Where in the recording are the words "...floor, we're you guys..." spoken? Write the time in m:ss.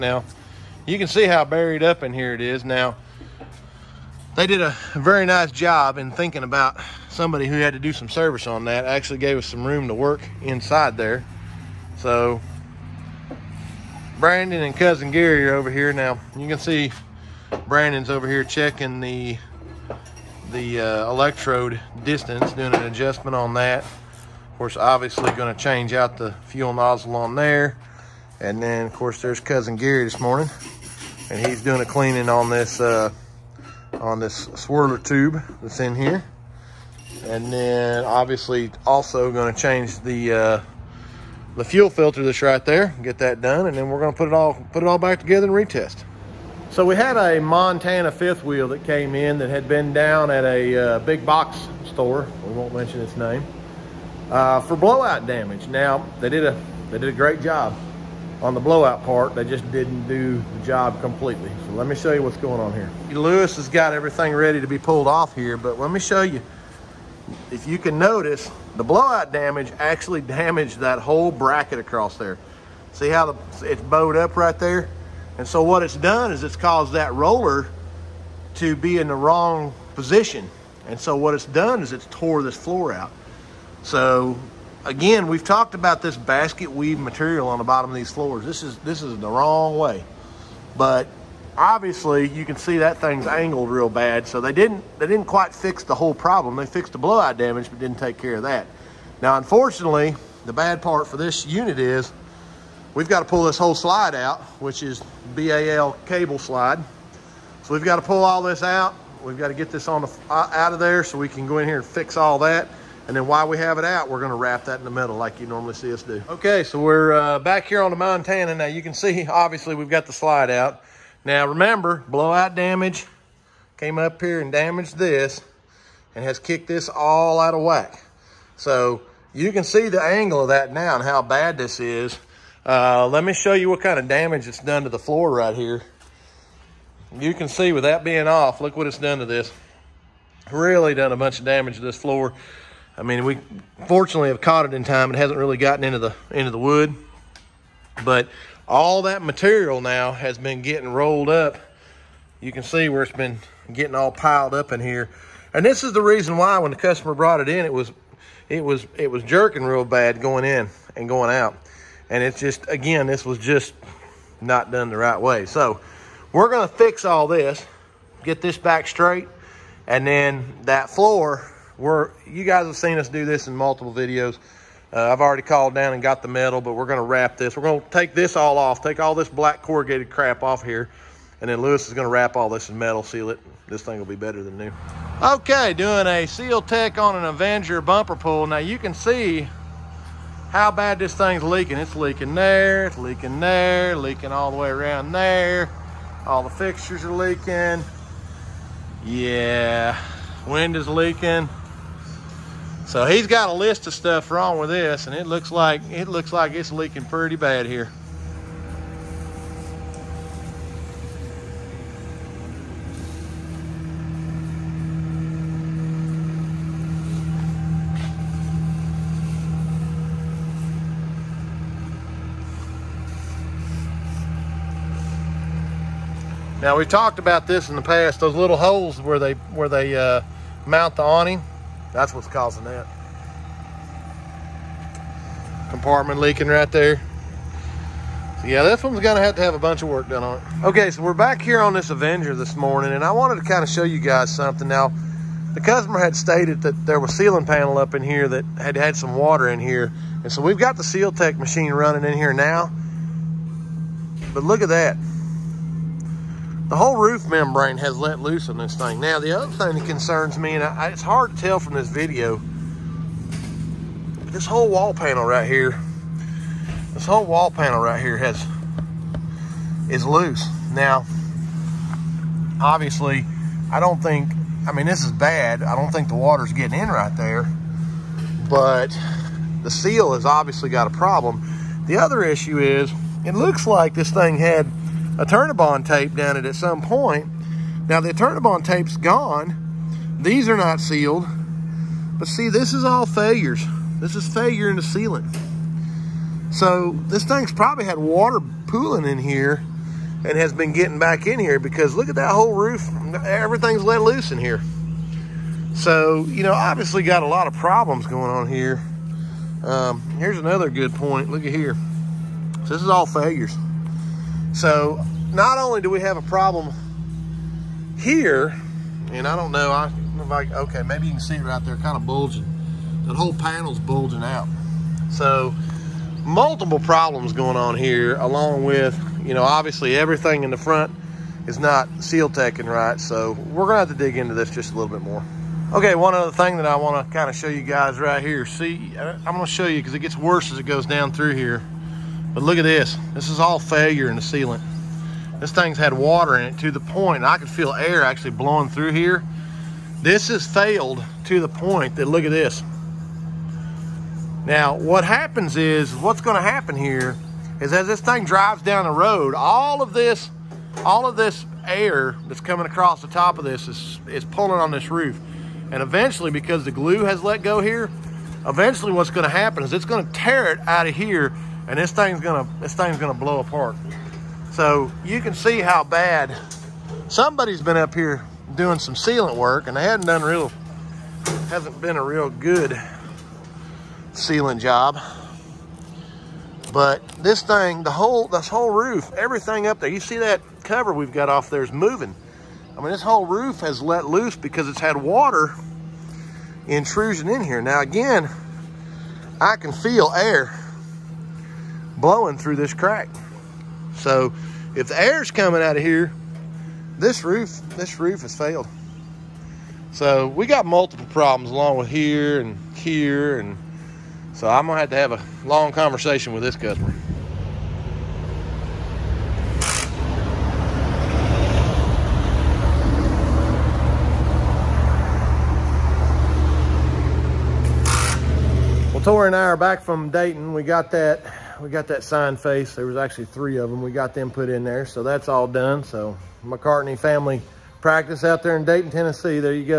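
2:50.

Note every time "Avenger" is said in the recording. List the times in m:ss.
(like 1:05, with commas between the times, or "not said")
3:07, 4:01.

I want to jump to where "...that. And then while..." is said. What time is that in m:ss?
1:52.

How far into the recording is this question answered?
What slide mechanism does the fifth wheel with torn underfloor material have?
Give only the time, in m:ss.
1:45.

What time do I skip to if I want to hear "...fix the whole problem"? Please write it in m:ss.
1:35.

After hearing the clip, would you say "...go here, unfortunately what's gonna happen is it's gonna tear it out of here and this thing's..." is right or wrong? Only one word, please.
wrong.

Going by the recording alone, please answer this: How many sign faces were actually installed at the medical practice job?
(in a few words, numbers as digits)
3.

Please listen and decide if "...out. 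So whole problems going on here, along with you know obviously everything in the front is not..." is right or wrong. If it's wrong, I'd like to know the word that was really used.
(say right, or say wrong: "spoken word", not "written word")
wrong: "multiple", not "whole".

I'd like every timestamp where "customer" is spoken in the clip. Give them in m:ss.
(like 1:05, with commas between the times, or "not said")
2:36, 4:05, 6:56.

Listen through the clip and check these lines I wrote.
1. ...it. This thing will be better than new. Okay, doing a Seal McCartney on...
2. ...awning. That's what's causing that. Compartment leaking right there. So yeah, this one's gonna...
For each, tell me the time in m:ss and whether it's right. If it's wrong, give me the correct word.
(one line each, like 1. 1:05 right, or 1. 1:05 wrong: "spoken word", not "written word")
1. 3:03 wrong: "Tech", not "McCartney"
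2. 3:51 right.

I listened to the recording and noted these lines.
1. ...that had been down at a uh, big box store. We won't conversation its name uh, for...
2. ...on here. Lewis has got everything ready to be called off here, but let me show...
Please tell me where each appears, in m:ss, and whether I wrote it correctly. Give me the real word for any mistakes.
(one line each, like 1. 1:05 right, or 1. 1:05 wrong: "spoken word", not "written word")
1. 0:49 wrong: "mention", not "conversation"
2. 1:02 wrong: "pulled", not "called".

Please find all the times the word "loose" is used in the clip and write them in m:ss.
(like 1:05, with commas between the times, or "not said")
4:18, 4:30, 5:04, 6:34.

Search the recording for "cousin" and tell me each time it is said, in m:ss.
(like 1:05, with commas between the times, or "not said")
0:14, 0:29.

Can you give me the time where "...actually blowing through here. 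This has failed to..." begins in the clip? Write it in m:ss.
5:48.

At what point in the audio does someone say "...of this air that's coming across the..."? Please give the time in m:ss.
6:01.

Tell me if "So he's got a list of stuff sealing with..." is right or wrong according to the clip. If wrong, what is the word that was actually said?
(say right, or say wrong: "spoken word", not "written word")
wrong: "wrong", not "sealing".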